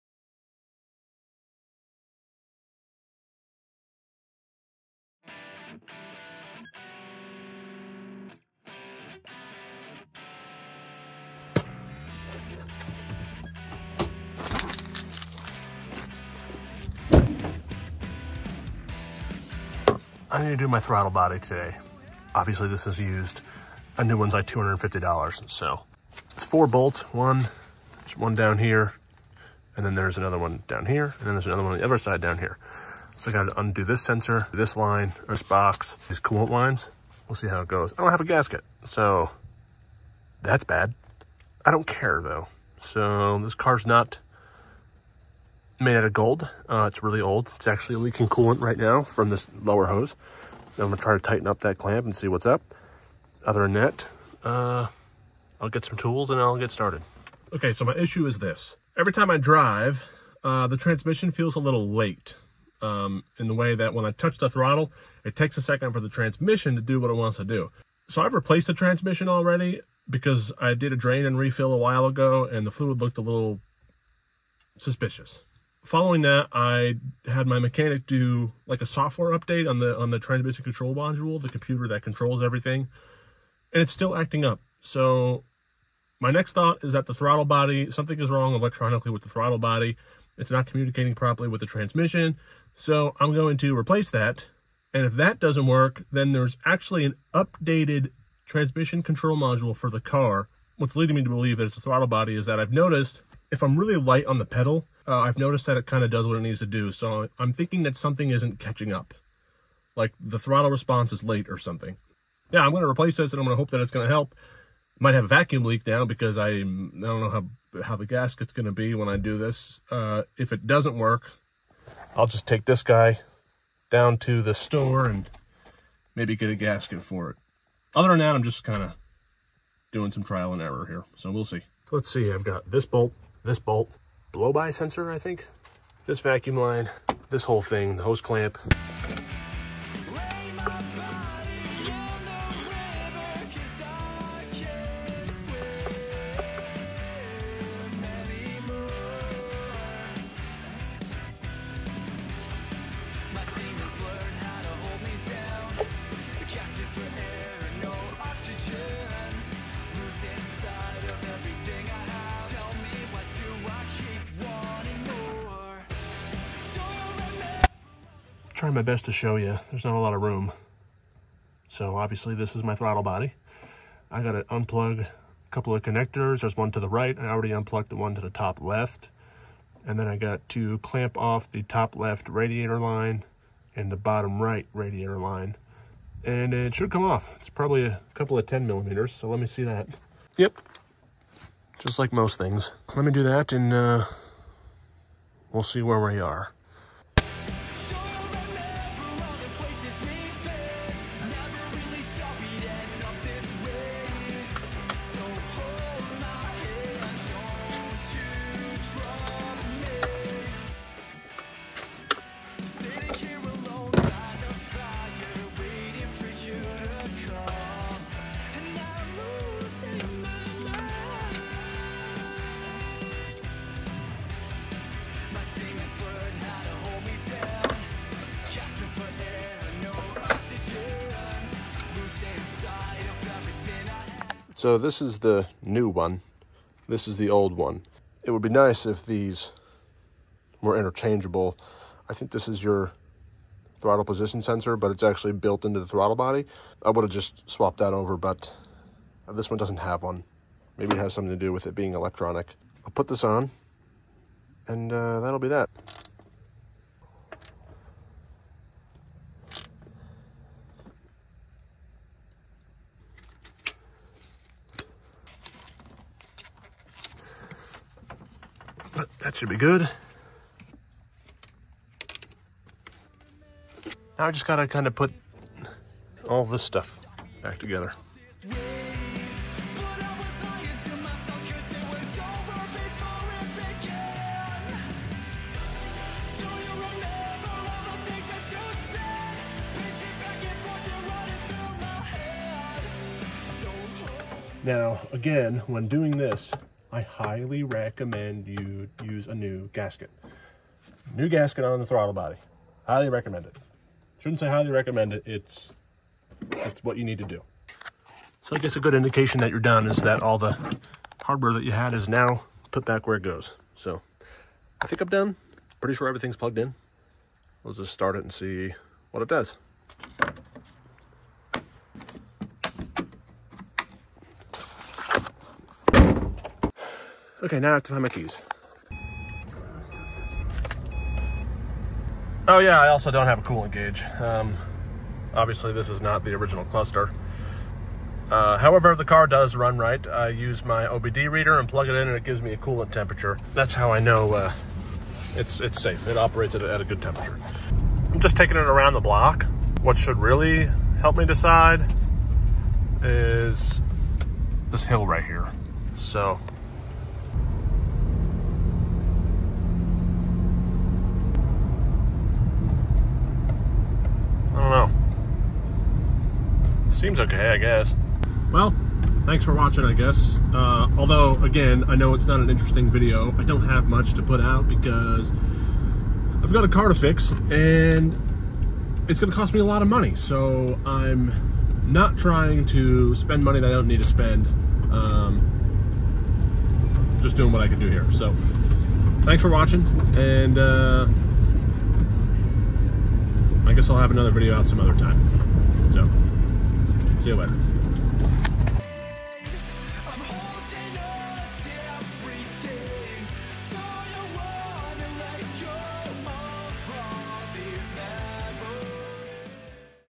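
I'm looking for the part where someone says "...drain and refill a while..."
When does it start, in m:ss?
1:10.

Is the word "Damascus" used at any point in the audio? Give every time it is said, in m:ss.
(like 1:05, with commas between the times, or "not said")
not said.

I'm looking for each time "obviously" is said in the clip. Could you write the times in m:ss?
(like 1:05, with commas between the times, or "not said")
0:22, 2:51, 5:35.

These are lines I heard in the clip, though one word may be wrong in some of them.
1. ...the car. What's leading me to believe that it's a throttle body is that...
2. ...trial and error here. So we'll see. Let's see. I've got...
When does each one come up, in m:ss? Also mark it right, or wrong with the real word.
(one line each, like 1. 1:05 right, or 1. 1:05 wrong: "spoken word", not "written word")
1. 1:39 right
2. 2:10 right.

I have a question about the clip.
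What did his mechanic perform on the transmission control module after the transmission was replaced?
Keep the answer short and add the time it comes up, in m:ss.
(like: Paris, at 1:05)
software update, at 1:18.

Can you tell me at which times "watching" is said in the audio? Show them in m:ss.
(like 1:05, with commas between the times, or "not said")
6:09, 6:29.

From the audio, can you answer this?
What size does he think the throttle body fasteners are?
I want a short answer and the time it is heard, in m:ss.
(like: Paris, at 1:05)
10 millimeters, at 3:08.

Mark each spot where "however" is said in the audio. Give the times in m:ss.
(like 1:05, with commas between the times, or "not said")
5:38.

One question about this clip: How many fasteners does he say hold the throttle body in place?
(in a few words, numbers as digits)
4.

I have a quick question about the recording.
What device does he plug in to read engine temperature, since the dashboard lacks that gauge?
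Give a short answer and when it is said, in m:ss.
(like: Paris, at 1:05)
OBD reader, at 5:40.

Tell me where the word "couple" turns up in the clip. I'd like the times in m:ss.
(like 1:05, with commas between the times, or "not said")
2:55, 3:08.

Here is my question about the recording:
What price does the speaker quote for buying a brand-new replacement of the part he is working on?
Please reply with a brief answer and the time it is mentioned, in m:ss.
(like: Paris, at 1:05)
$250, at 0:24.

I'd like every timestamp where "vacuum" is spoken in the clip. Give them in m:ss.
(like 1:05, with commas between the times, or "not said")
1:55, 2:16.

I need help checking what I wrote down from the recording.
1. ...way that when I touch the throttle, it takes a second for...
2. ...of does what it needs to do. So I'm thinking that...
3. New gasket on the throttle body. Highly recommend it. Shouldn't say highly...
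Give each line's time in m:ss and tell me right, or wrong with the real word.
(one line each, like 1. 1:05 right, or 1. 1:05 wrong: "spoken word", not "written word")
1. 1:03 right
2. 1:46 right
3. 5:01 right.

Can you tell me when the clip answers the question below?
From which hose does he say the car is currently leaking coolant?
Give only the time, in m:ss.
0:49.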